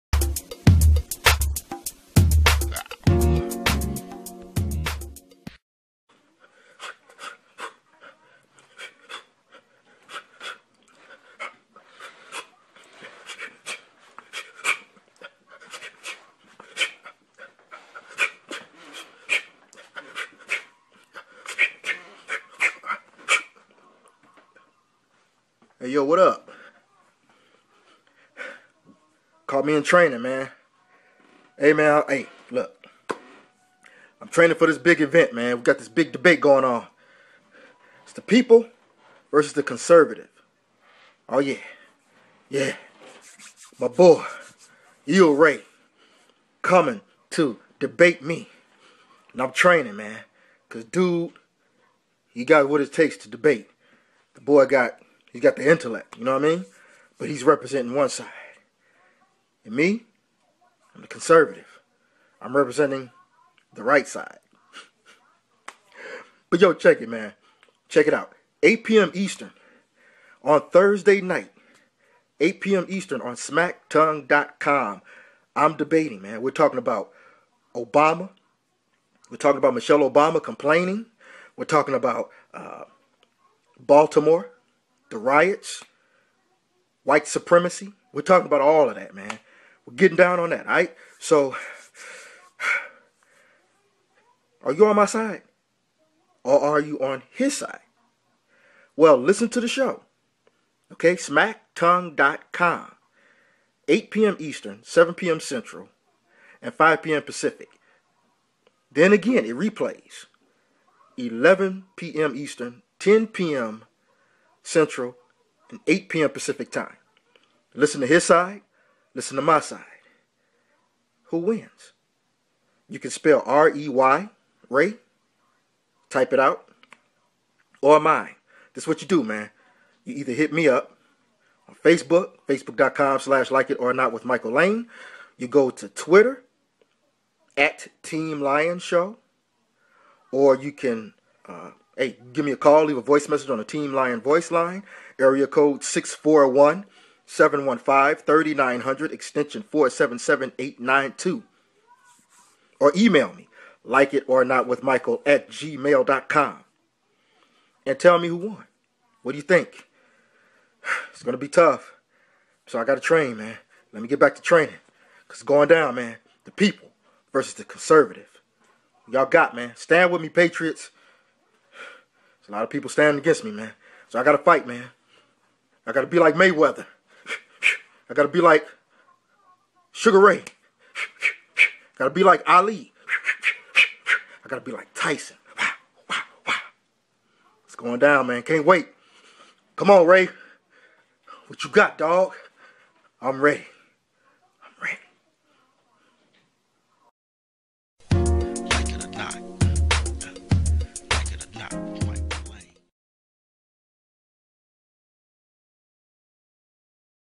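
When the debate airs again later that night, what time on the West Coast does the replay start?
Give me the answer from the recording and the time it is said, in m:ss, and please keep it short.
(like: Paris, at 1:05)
8 p.m. Pacific, at 1:55.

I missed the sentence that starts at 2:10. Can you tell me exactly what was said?
You either hit me up on Facebook, facebook.com slash like it or not with Michael Lane.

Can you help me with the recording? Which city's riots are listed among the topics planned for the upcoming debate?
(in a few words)
Baltimore.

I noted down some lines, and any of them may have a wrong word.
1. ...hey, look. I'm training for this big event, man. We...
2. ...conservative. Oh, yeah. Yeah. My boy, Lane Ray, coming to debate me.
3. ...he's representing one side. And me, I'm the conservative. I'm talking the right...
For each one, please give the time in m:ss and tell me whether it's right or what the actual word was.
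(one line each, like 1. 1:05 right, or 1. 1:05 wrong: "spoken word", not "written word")
1. 0:32 right
2. 0:39 wrong: "Eel", not "Lane"
3. 0:57 wrong: "representing", not "talking".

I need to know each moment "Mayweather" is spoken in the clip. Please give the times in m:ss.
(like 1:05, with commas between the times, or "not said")
2:56.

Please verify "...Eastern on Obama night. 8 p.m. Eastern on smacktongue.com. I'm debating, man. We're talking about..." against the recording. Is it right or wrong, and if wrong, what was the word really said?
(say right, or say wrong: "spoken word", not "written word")
wrong: "Thursday", not "Obama".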